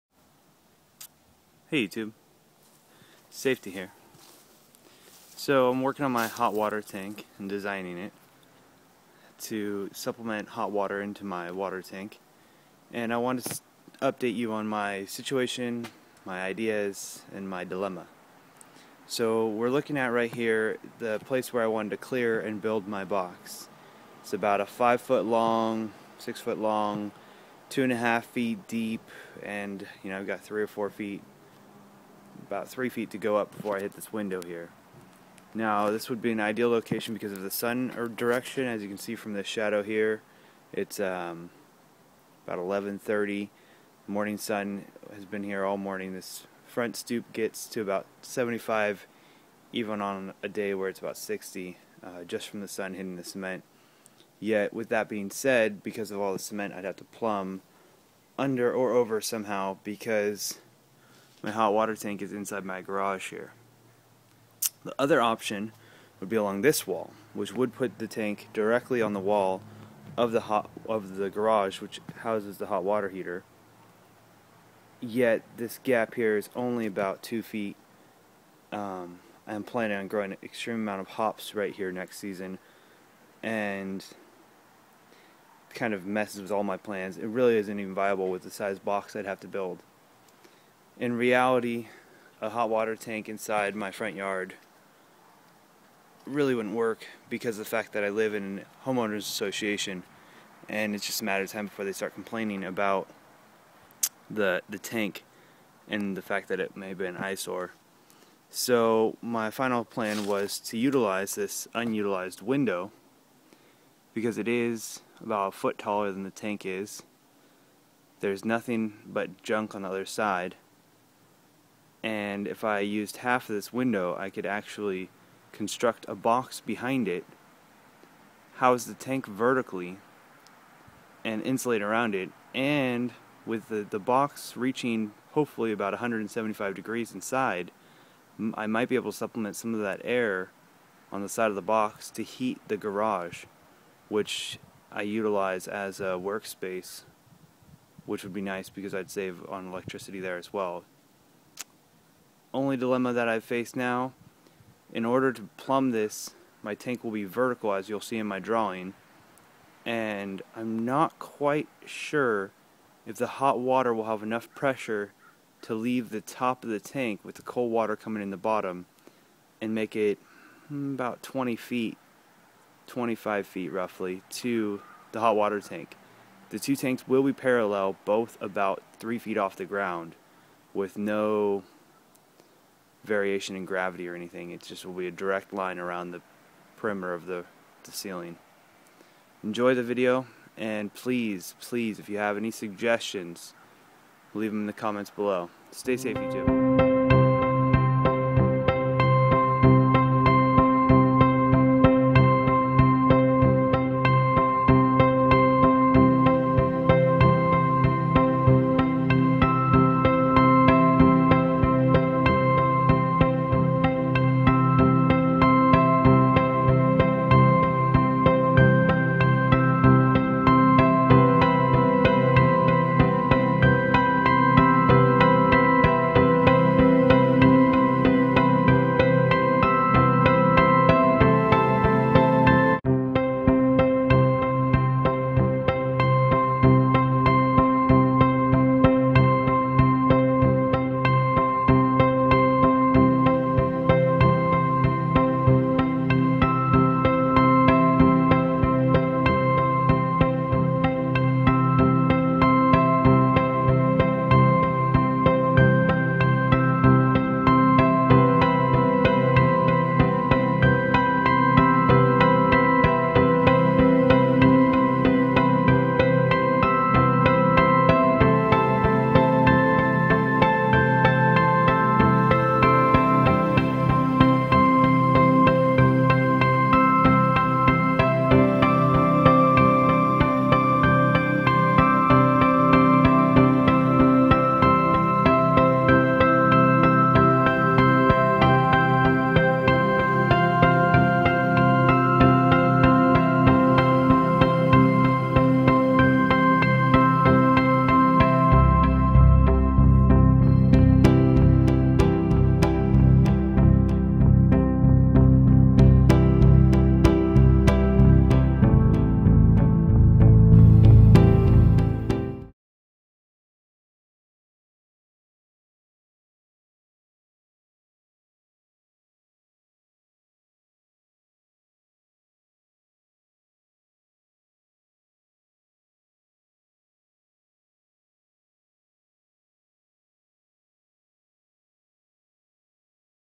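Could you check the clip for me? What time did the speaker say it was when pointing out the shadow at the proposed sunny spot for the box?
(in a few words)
11:30.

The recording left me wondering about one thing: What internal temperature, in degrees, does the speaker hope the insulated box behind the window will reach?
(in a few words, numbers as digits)
175.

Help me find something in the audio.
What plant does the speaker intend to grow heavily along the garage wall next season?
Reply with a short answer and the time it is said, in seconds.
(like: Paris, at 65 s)
hops, at 81 s.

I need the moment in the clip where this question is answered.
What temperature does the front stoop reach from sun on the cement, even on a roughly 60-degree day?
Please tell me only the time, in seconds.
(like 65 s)
48 s.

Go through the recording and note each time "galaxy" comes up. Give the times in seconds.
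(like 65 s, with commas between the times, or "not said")
not said.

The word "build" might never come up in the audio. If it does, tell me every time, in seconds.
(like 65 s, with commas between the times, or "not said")
22 s, 89 s.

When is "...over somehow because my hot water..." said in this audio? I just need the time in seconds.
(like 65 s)
58 s.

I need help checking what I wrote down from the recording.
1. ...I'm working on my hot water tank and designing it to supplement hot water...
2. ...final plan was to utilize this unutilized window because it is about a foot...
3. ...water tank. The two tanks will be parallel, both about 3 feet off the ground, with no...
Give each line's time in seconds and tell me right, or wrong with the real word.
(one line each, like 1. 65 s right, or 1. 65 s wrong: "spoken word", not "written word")
1. 5 s right
2. 109 s right
3. 175 s right.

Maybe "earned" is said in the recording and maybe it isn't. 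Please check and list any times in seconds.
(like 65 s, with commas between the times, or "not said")
not said.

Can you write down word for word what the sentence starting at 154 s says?
In order to plumb this, my tank will be vertical as you'll see in my drawing.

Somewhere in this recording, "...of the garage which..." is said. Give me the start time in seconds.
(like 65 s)
70 s.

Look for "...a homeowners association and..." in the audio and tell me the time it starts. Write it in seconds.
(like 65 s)
98 s.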